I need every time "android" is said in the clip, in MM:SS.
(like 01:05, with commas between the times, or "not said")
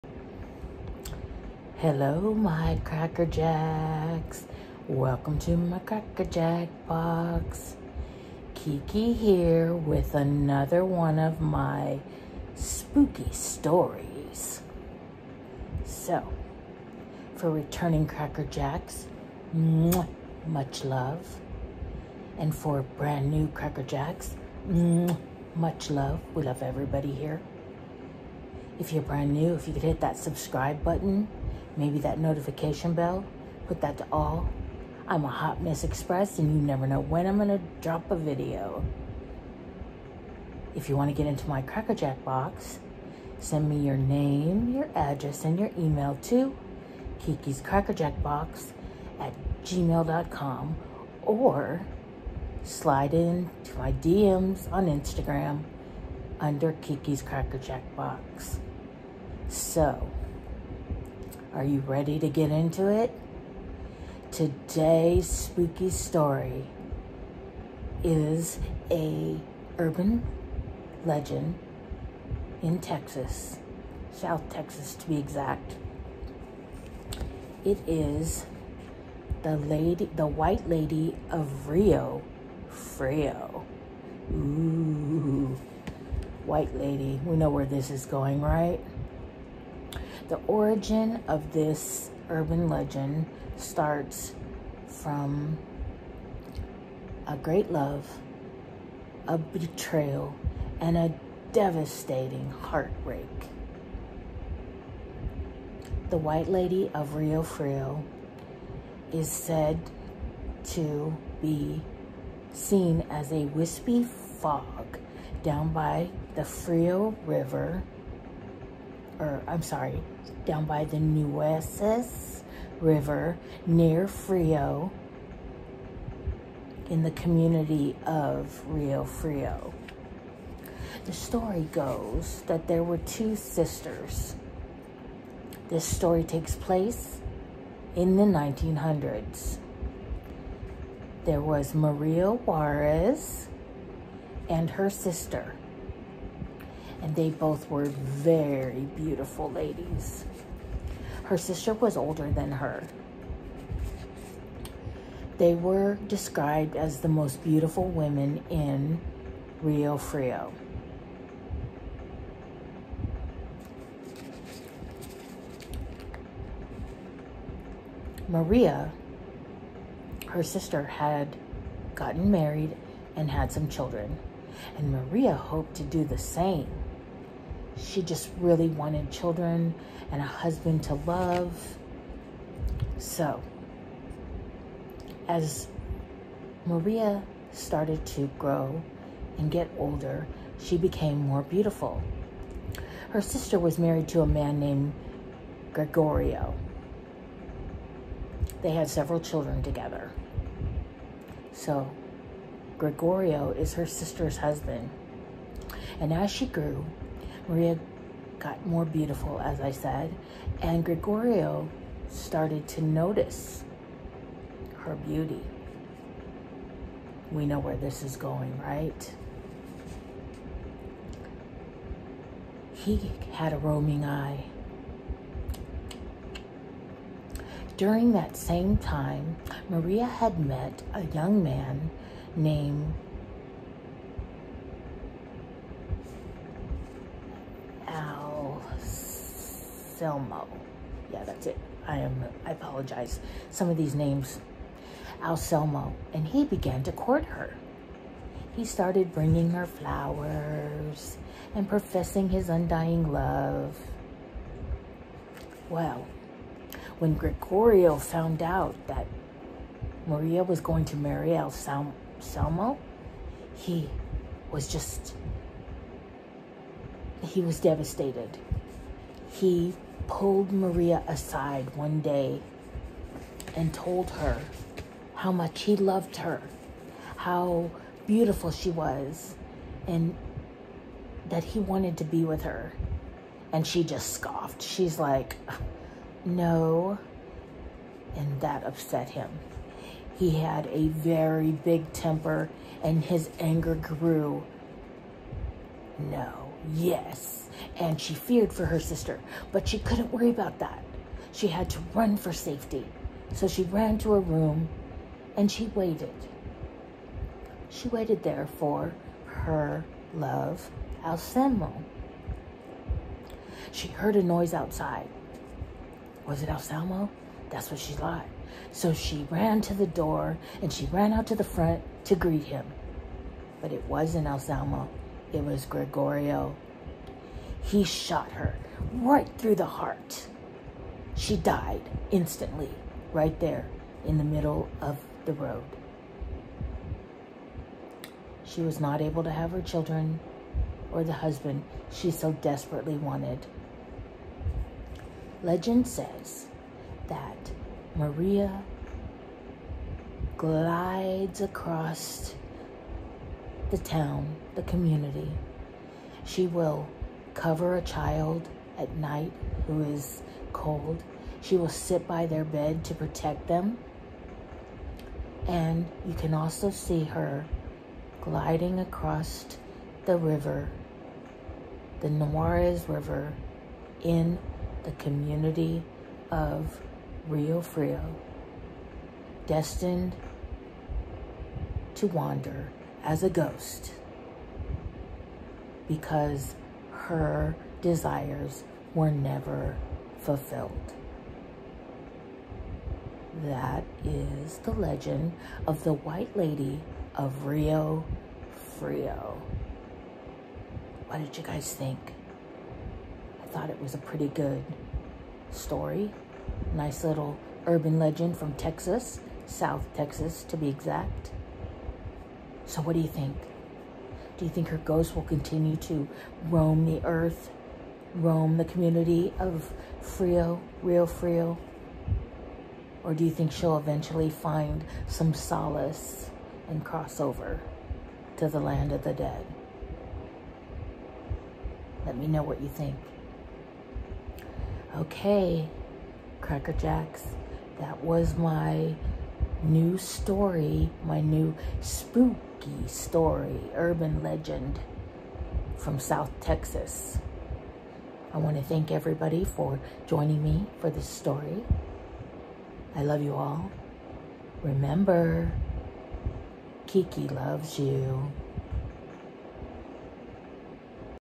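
not said.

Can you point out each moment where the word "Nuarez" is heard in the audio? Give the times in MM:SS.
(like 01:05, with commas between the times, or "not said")
06:12.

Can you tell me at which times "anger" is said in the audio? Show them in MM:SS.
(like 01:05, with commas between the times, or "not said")
04:53.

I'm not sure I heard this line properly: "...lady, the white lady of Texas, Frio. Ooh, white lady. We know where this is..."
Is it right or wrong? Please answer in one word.
wrong.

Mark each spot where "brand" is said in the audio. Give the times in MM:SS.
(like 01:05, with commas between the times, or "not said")
00:22, 00:29.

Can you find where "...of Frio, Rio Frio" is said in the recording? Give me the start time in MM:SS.
06:59.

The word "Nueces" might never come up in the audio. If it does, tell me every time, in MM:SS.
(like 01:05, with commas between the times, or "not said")
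02:00.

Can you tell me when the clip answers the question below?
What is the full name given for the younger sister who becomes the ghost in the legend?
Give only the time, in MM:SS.
02:21.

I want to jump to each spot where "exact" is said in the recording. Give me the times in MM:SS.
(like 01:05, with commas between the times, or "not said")
01:15, 06:50.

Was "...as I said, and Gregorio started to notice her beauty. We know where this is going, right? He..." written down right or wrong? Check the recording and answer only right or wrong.
right.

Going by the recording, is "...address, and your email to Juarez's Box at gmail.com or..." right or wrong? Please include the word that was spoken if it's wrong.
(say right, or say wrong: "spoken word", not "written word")
wrong: "Kiki", not "Juarez".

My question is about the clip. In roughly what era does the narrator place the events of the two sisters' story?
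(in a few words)
1900s.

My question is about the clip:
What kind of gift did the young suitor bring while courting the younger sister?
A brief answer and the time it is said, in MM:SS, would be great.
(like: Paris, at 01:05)
flowers, at 04:09.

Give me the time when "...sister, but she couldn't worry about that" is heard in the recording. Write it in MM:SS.
04:58.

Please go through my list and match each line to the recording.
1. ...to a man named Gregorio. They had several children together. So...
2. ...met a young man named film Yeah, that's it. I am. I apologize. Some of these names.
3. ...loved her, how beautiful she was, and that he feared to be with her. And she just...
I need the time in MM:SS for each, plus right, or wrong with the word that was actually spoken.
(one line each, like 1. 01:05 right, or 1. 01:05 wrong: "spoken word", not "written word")
1. 03:14 right
2. 03:50 right
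3. 04:35 wrong: "wanted", not "feared".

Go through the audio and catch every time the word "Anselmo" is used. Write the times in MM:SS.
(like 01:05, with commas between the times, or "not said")
05:11, 05:16, 05:24.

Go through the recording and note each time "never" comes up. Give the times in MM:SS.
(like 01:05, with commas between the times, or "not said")
00:36, 06:29.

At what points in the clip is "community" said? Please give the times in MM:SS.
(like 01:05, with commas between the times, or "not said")
02:07, 05:54, 06:14, 06:58.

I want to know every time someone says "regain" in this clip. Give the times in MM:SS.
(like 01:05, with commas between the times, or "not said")
not said.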